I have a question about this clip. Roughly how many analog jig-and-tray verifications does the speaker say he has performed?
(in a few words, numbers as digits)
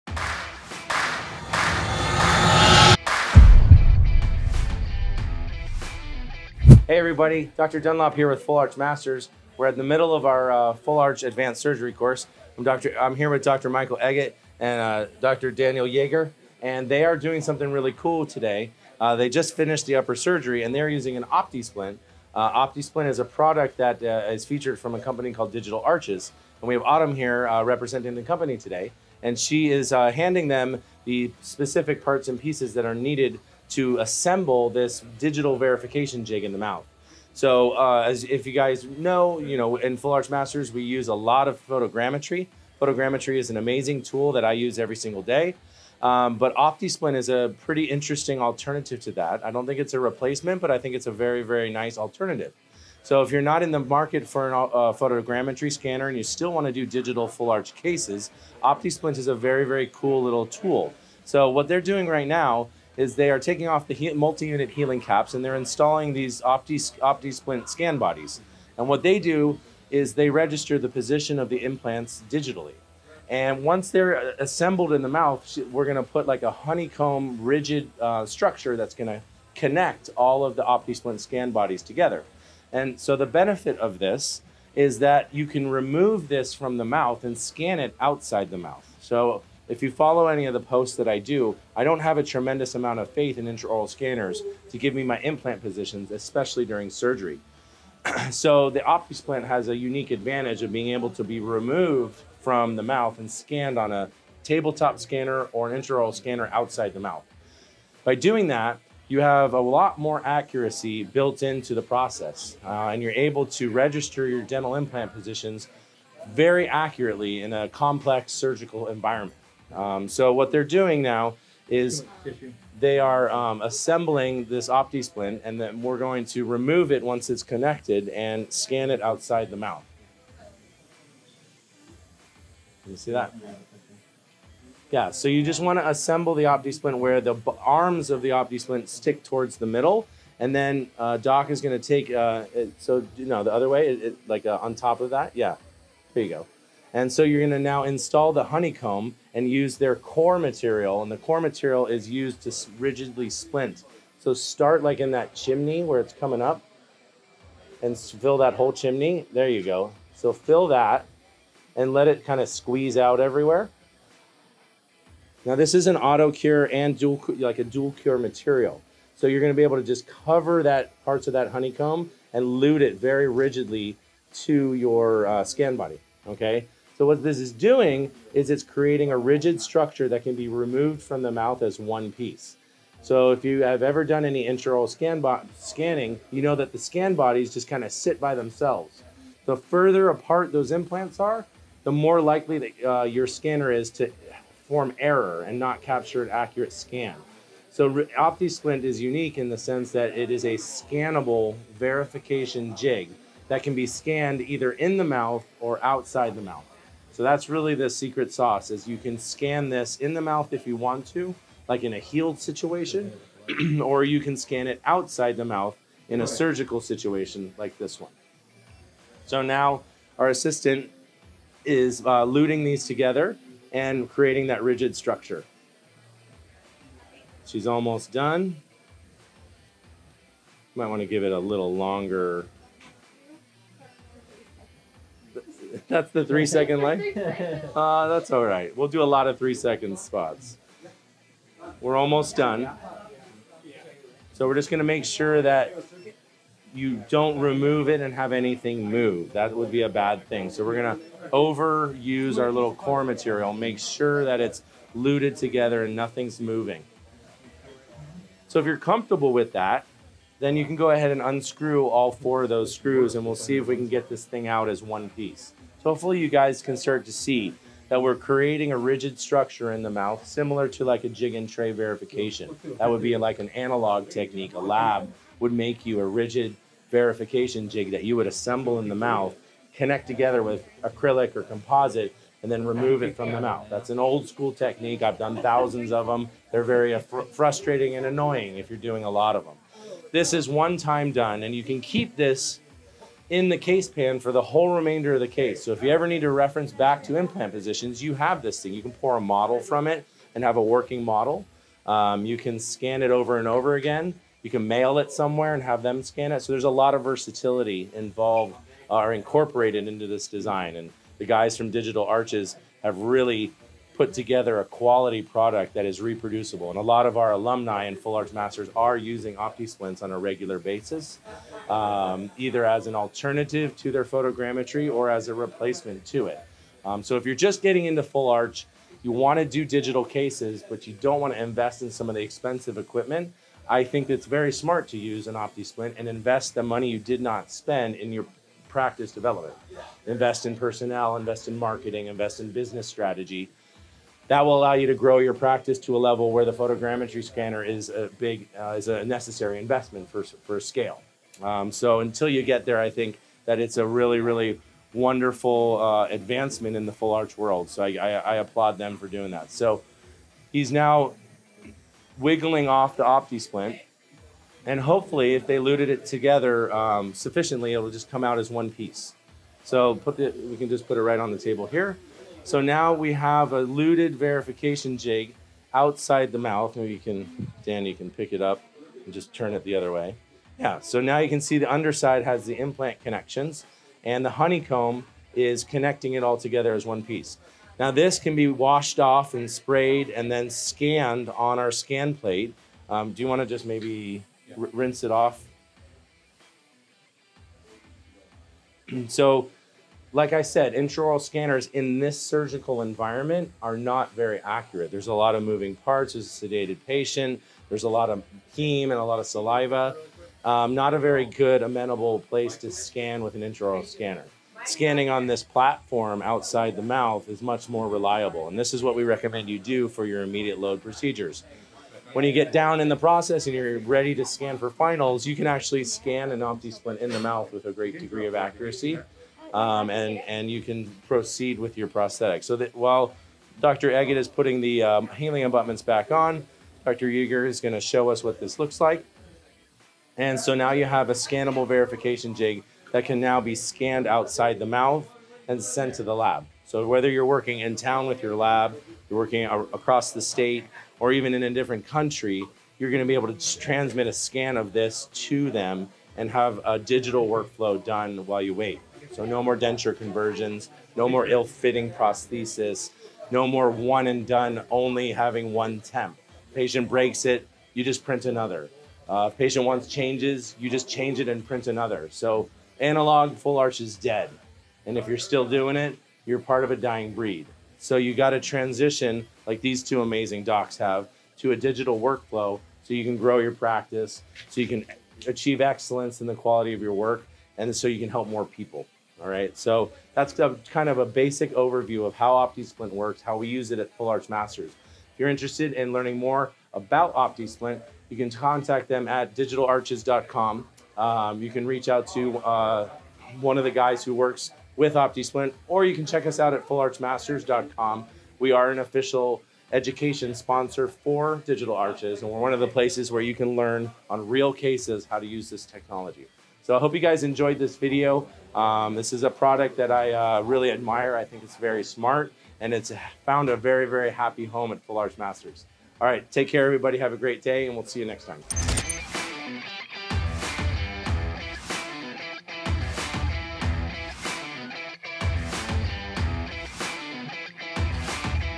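thousands.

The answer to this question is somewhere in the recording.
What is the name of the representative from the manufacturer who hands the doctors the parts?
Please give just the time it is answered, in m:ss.
0:26.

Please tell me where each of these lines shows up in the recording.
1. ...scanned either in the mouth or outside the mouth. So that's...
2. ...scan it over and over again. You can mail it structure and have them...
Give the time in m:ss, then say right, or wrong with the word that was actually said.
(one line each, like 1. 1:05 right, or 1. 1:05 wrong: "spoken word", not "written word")
1. 3:23 right
2. 5:02 wrong: "somewhere", not "structure".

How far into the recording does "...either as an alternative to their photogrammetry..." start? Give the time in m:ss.
5:22.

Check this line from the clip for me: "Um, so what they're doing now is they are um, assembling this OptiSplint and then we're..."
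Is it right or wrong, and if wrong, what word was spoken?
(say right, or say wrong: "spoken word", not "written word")
right.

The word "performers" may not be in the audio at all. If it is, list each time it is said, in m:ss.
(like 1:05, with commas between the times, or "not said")
not said.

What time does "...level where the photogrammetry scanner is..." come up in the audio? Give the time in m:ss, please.
5:45.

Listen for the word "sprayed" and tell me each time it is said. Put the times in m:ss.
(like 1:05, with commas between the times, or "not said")
6:29.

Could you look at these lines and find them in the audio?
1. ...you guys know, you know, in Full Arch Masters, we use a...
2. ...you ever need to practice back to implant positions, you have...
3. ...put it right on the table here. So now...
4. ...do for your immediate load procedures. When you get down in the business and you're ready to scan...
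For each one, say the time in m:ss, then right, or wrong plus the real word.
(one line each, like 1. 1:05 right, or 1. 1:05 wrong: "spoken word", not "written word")
1. 0:38 right
2. 4:55 wrong: "reference", not "practice"
3. 6:10 right
4. 6:59 wrong: "process", not "business".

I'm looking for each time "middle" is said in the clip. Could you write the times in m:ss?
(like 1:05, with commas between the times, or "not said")
0:09, 2:19.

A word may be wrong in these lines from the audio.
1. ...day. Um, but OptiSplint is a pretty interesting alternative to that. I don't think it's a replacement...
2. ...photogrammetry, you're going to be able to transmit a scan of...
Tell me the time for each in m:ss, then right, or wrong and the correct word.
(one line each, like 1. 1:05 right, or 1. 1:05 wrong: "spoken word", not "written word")
1. 0:45 right
2. 7:31 wrong: "country", not "photogrammetry".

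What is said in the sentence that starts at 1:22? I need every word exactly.
And so the benefit of this is that you can remove this from the mouth and scan it outside the mouth.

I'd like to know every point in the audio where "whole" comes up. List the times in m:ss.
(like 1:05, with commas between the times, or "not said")
2:38, 4:54.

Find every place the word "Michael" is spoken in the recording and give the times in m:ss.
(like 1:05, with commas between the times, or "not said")
0:13.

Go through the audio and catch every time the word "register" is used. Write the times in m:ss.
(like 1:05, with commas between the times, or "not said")
1:10, 1:53.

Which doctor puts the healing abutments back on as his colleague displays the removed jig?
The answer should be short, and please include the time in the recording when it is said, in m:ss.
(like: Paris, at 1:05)
Dr. Eggett, at 7:13.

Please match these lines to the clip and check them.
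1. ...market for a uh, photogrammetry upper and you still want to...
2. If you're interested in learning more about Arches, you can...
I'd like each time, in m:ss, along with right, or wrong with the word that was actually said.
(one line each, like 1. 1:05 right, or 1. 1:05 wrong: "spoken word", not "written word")
1. 0:53 wrong: "scanner", not "upper"
2. 8:14 wrong: "OptiSplint", not "Arches".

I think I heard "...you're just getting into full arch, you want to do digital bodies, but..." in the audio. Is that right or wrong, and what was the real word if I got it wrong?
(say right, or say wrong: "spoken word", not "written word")
wrong: "cases", not "bodies".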